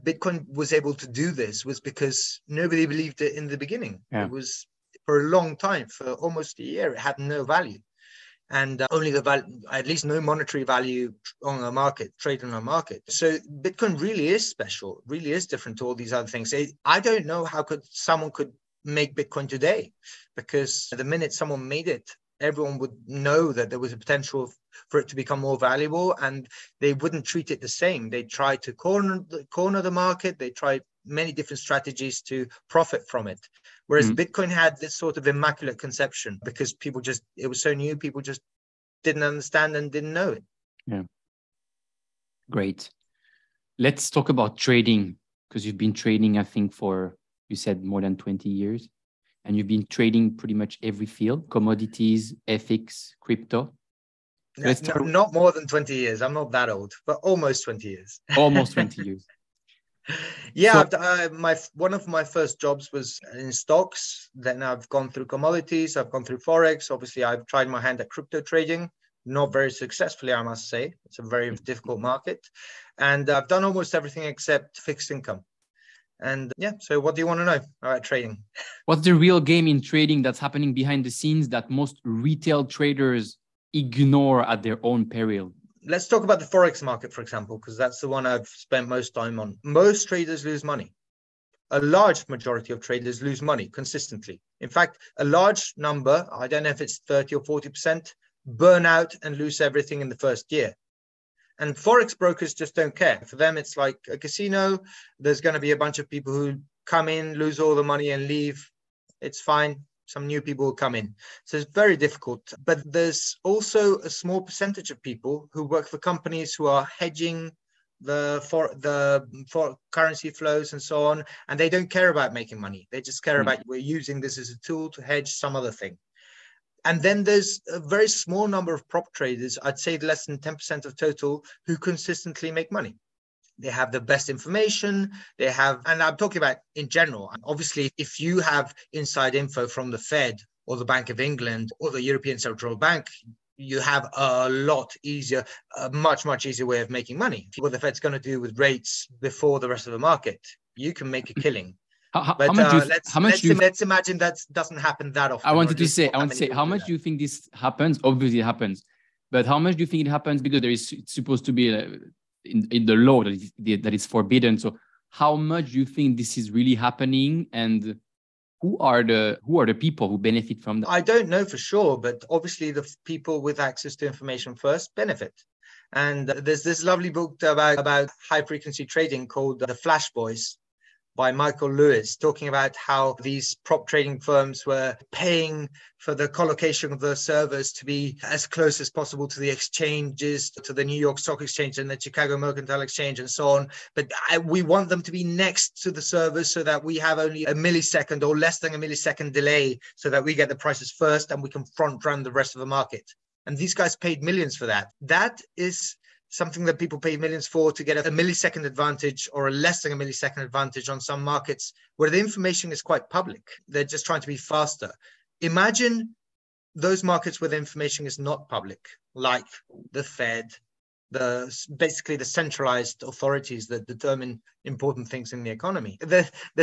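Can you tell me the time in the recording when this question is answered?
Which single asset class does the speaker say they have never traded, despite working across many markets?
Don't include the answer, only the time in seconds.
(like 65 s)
74 s.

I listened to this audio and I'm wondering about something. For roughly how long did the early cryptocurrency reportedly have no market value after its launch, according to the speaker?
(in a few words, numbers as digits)
almost a year.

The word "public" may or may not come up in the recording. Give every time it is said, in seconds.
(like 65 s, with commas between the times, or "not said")
213 s, 218 s.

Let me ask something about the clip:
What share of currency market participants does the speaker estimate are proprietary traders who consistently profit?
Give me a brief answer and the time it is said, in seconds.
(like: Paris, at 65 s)
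less than 10%, at 129 s.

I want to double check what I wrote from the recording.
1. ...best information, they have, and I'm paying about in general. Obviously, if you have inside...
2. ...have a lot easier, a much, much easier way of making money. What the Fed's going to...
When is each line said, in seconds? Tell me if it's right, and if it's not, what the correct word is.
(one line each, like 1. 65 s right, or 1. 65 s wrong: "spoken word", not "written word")
1. 133 s wrong: "talking", not "paying"
2. 143 s right.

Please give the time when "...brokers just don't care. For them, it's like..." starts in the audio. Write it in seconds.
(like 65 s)
102 s.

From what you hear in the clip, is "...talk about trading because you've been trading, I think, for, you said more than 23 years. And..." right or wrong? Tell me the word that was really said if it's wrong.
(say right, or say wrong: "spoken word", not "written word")
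wrong: "20", not "23".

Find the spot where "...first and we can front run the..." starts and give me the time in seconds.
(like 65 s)
200 s.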